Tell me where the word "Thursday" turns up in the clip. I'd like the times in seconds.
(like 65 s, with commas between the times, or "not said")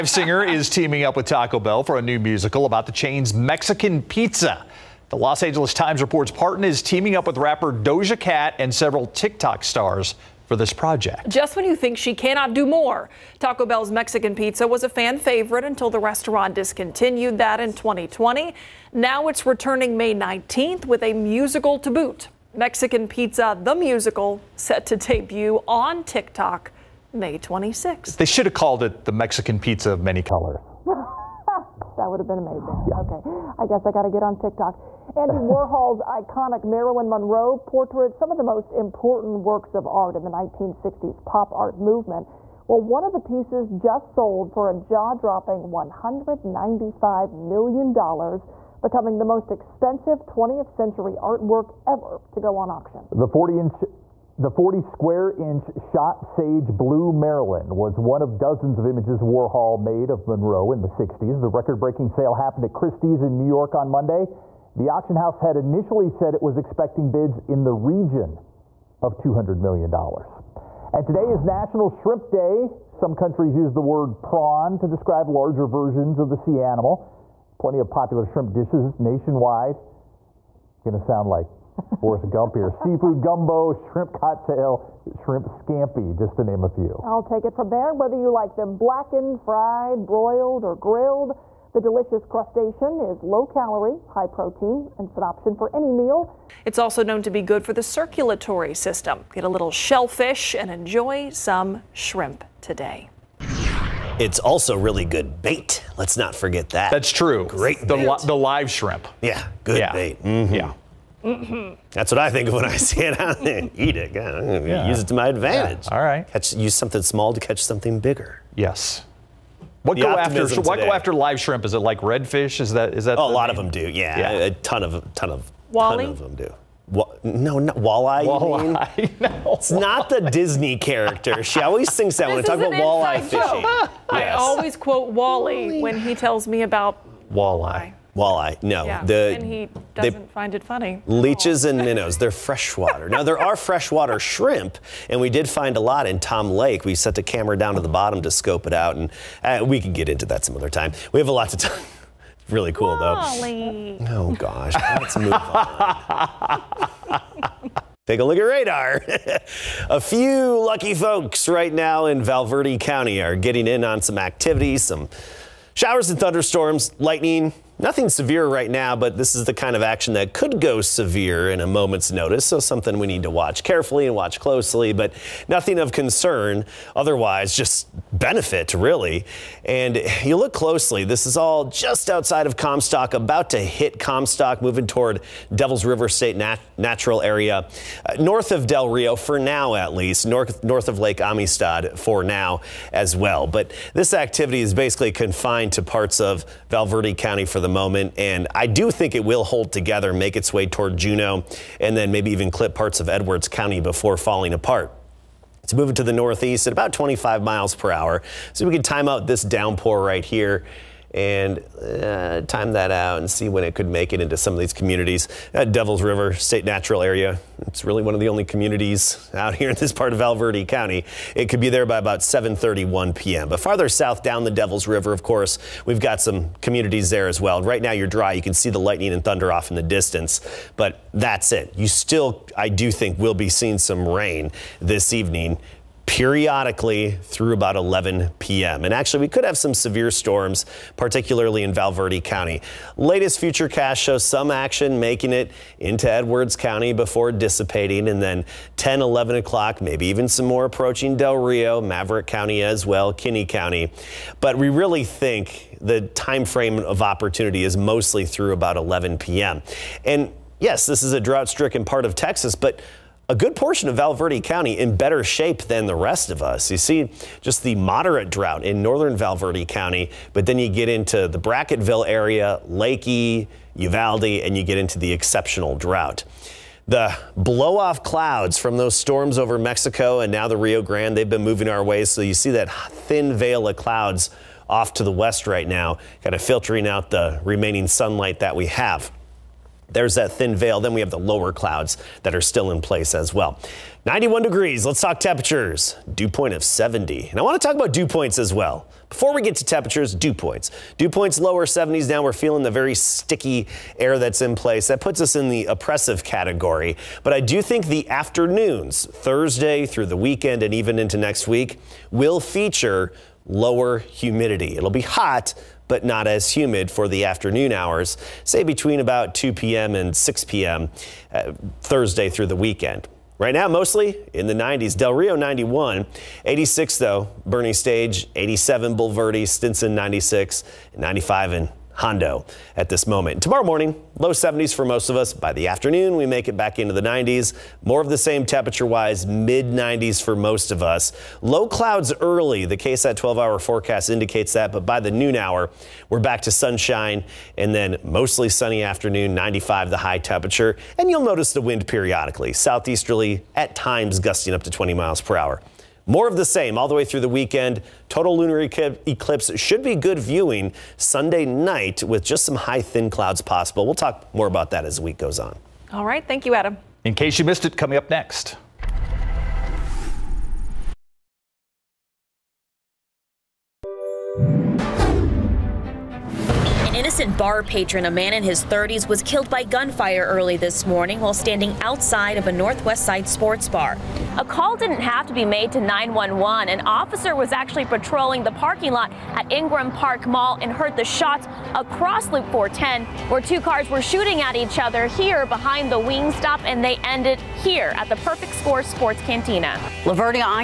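309 s, 321 s.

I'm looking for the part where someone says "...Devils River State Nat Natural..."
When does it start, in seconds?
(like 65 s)
185 s.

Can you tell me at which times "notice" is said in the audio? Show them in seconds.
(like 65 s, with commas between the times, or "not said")
172 s, 351 s.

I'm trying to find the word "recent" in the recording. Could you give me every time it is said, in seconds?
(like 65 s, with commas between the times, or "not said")
377 s.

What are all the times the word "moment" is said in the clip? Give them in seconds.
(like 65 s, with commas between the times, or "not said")
171 s, 197 s, 333 s.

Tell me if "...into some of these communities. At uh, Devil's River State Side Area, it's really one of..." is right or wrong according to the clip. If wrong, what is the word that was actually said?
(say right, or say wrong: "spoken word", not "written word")
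wrong: "Natural", not "Side".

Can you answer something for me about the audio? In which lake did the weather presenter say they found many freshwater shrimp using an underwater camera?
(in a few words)
Tom Lake.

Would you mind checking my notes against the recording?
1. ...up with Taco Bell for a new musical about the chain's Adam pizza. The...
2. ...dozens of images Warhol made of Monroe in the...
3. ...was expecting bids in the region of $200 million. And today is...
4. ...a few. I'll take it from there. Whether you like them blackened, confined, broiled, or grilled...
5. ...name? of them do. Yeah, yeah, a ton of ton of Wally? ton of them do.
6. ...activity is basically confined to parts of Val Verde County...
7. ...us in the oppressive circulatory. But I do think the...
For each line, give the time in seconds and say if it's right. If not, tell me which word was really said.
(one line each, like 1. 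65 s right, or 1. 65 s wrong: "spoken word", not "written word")
1. 1 s wrong: "Mexican", not "Adam"
2. 58 s right
3. 66 s right
4. 86 s wrong: "fried", not "confined"
5. 123 s right
6. 194 s right
7. 305 s wrong: "category", not "circulatory".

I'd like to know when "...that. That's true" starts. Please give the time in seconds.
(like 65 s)
106 s.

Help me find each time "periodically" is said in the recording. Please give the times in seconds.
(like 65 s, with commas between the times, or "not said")
236 s, 351 s.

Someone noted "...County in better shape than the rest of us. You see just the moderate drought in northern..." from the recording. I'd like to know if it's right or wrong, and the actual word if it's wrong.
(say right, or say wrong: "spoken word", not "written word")
right.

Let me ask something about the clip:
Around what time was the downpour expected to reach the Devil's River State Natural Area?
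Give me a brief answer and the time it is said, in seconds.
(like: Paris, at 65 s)
7:31 p.m., at 222 s.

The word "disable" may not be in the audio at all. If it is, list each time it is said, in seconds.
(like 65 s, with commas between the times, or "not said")
not said.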